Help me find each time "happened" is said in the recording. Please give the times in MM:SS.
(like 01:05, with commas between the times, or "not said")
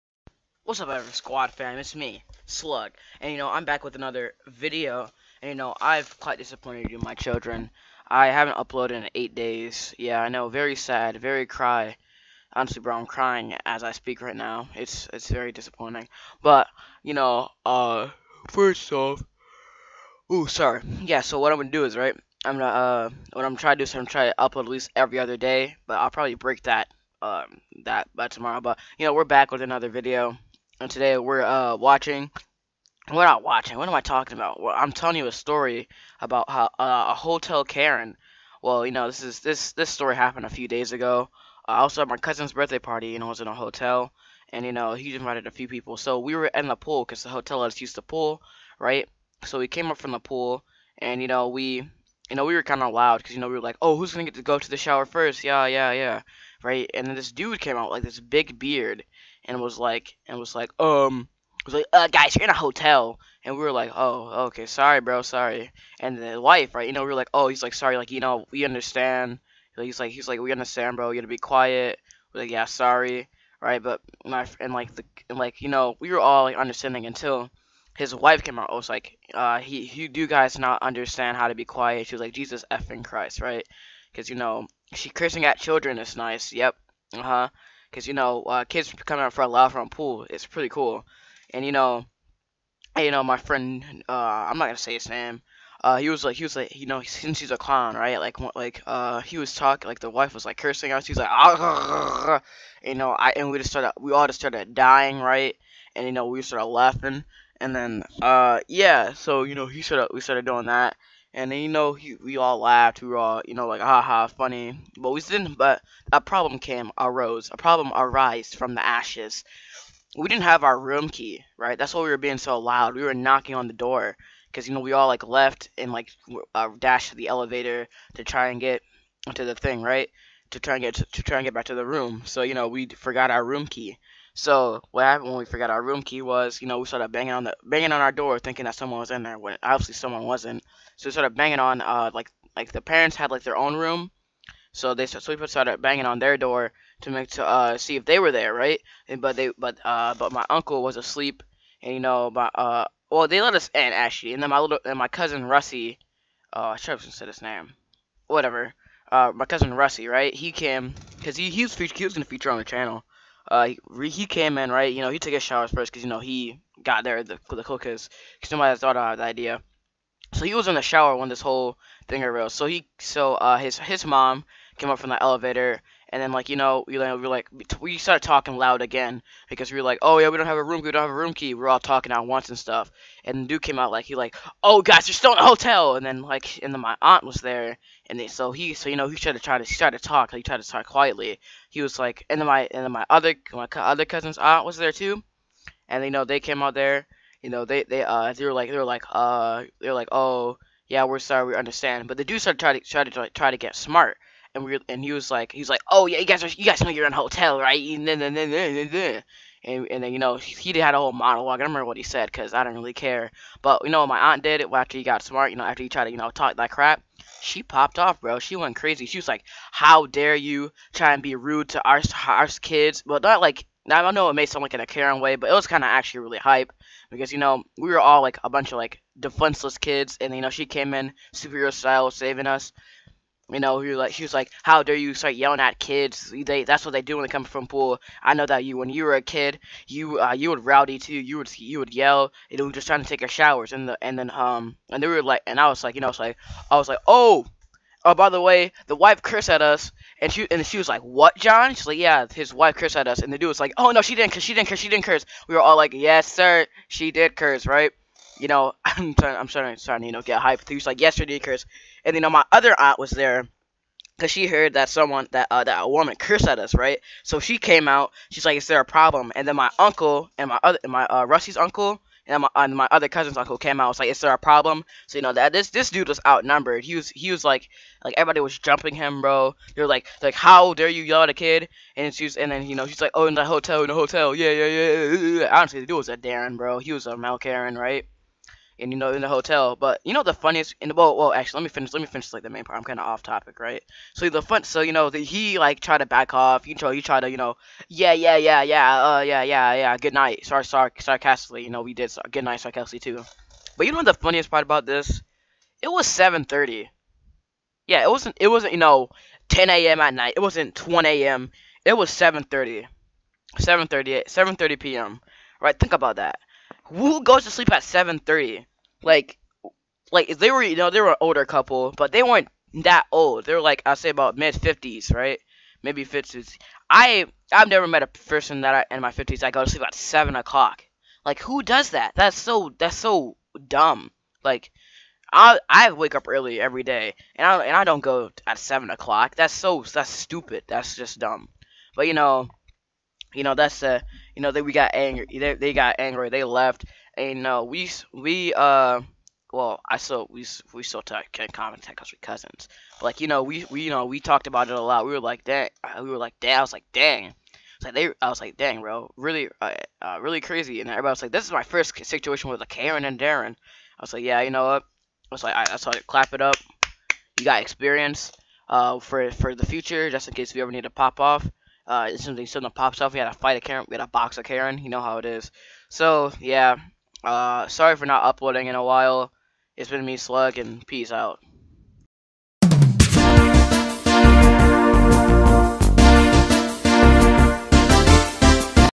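00:40, 02:15.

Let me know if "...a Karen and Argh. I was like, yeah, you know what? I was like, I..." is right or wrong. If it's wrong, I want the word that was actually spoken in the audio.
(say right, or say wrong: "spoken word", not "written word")
wrong: "Darren", not "Argh".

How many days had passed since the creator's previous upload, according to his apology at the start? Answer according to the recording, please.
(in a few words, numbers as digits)
8 days.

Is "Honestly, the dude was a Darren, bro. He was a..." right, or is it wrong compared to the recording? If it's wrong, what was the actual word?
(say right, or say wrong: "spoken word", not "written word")
right.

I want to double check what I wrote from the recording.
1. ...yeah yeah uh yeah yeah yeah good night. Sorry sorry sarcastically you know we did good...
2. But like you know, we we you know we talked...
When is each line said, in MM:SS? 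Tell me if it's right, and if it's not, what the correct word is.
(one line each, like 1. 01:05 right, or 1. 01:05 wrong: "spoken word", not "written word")
1. 04:58 right
2. 05:52 right.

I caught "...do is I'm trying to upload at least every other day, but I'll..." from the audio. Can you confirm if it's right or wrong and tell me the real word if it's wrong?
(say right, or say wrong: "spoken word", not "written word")
right.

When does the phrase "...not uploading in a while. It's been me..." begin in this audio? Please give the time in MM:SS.
06:18.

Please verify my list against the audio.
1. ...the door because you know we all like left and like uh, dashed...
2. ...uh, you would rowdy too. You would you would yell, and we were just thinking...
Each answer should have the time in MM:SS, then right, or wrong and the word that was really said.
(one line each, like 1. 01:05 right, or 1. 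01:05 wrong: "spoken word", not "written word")
1. 02:03 right
2. 04:00 wrong: "trying", not "thinking".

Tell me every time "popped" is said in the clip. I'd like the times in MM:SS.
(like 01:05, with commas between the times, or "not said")
03:37.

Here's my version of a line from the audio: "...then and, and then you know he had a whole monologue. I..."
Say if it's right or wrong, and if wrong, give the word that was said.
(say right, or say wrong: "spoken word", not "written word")
right.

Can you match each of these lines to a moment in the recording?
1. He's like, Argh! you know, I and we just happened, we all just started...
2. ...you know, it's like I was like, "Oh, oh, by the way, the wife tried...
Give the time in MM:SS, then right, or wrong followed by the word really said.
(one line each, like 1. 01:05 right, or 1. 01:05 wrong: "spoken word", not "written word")
1. 01:41 wrong: "started", not "happened"
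2. 04:05 wrong: "cursed", not "tried".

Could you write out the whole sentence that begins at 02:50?
So he was in the shower when this whole thing arose.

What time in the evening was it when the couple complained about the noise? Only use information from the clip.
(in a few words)
7:30 p.m.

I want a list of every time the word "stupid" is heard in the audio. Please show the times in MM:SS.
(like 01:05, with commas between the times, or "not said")
05:40.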